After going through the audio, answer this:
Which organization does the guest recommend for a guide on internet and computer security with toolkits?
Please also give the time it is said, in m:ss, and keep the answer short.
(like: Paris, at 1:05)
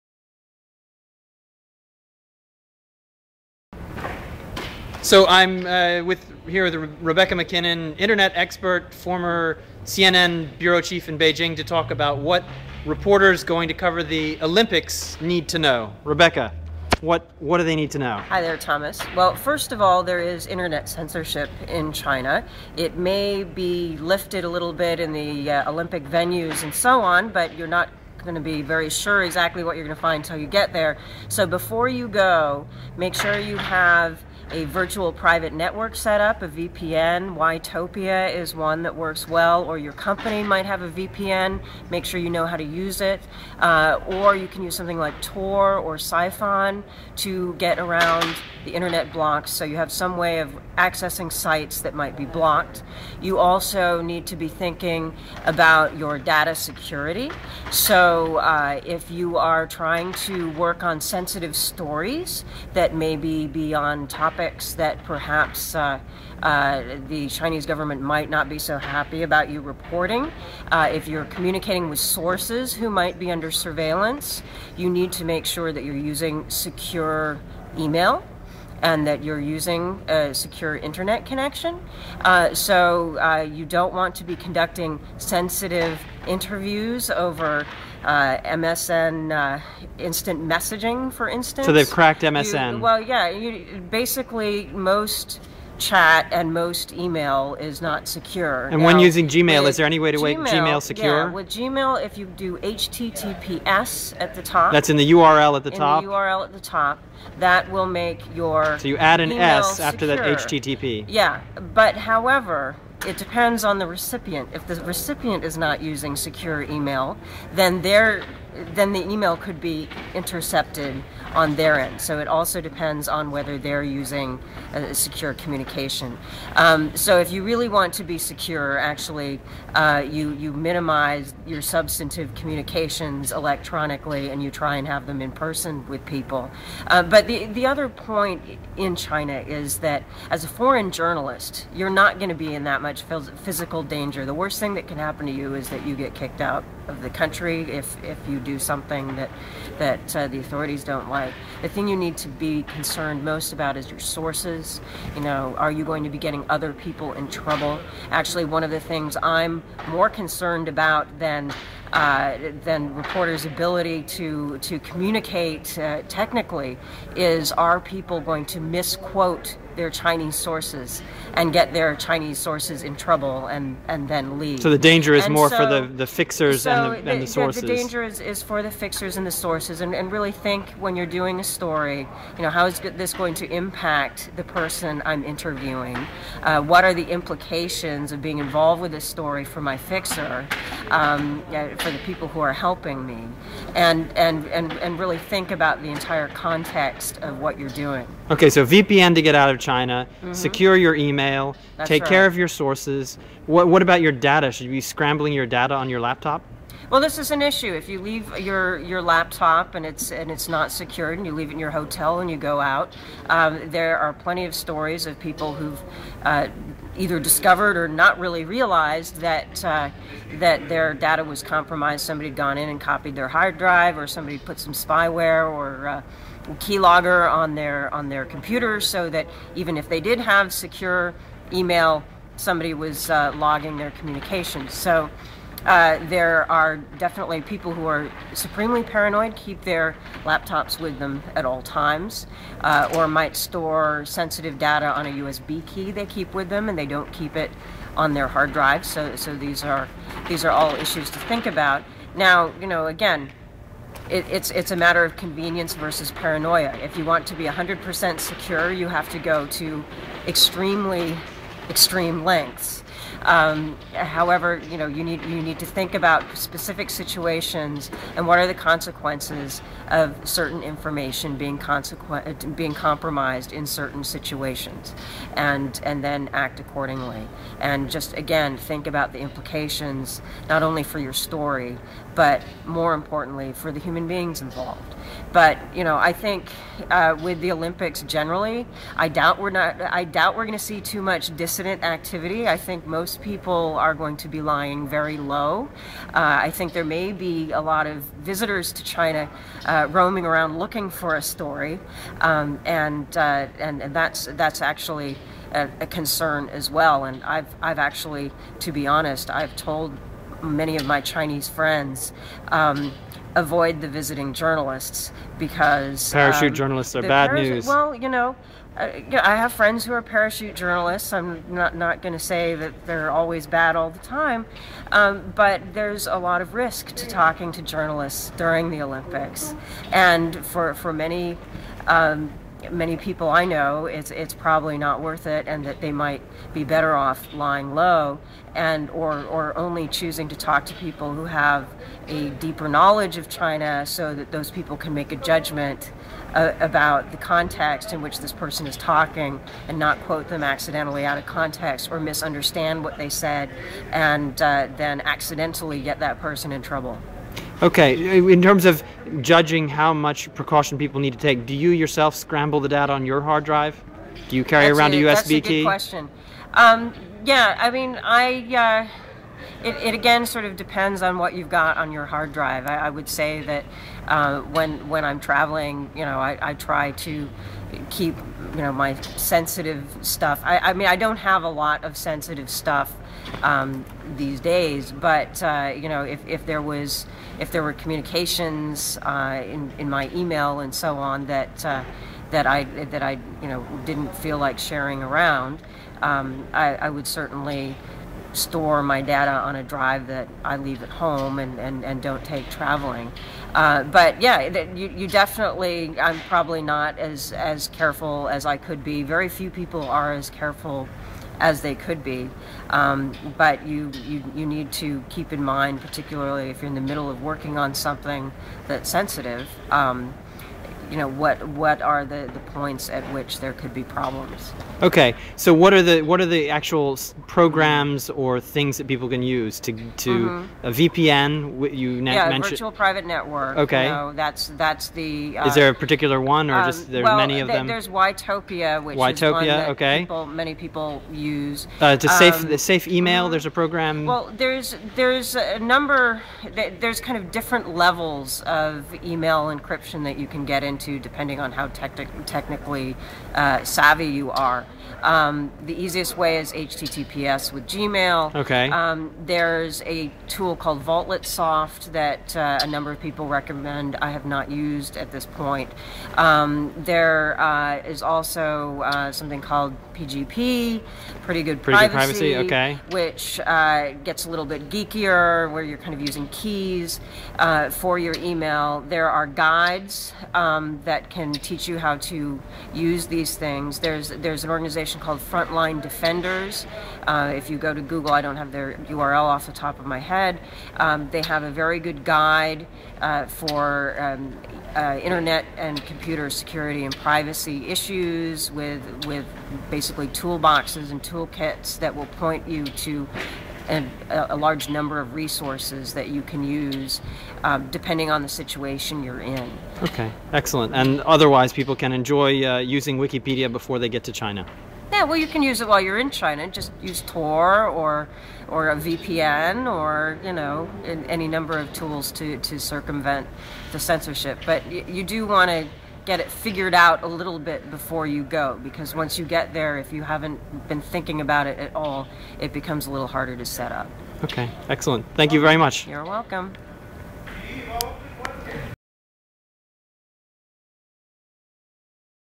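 Frontline Defenders, at 8:05.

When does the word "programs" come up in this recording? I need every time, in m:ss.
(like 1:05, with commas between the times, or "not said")
7:07, 7:23.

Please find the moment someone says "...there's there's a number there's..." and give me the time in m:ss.
7:24.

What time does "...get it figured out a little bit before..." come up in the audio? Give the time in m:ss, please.
8:46.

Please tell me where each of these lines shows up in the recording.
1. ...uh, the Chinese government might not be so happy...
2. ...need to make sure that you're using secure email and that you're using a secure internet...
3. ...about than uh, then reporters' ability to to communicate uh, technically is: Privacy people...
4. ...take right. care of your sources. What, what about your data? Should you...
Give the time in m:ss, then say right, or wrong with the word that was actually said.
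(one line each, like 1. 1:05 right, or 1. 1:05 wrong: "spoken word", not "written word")
1. 1:06 right
2. 1:14 right
3. 2:40 wrong: "Are", not "Privacy"
4. 3:21 right.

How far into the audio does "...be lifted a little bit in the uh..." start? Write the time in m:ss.
0:23.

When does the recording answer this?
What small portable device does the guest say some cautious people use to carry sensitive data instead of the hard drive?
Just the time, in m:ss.
4:05.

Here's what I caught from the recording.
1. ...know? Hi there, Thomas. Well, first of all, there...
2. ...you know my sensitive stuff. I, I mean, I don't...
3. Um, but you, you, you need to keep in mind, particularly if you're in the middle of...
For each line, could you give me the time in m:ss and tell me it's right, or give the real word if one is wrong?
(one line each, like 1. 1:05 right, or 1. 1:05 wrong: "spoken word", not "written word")
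1. 0:17 right
2. 6:18 right
3. 6:52 right.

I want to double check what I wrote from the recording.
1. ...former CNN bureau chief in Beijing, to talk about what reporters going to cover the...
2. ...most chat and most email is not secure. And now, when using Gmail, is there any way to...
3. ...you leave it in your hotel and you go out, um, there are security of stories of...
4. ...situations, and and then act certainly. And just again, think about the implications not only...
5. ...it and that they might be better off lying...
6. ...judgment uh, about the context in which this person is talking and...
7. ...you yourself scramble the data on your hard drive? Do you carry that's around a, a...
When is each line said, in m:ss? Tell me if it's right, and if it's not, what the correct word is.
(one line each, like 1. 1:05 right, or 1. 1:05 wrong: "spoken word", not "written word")
1. 0:08 right
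2. 1:34 right
3. 3:31 wrong: "plenty", not "security"
4. 4:34 wrong: "accordingly", not "certainly"
5. 5:35 right
6. 5:45 right
7. 6:01 right.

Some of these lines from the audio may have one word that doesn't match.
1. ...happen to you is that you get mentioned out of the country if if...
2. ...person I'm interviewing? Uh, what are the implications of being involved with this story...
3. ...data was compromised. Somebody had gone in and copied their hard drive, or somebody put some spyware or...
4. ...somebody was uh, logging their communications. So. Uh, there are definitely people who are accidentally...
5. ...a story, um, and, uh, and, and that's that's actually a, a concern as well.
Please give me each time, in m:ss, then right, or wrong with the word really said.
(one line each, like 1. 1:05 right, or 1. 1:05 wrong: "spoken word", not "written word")
1. 2:24 wrong: "kicked", not "mentioned"
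2. 3:04 right
3. 3:40 right
4. 3:52 wrong: "supremely", not "accidentally"
5. 5:01 right.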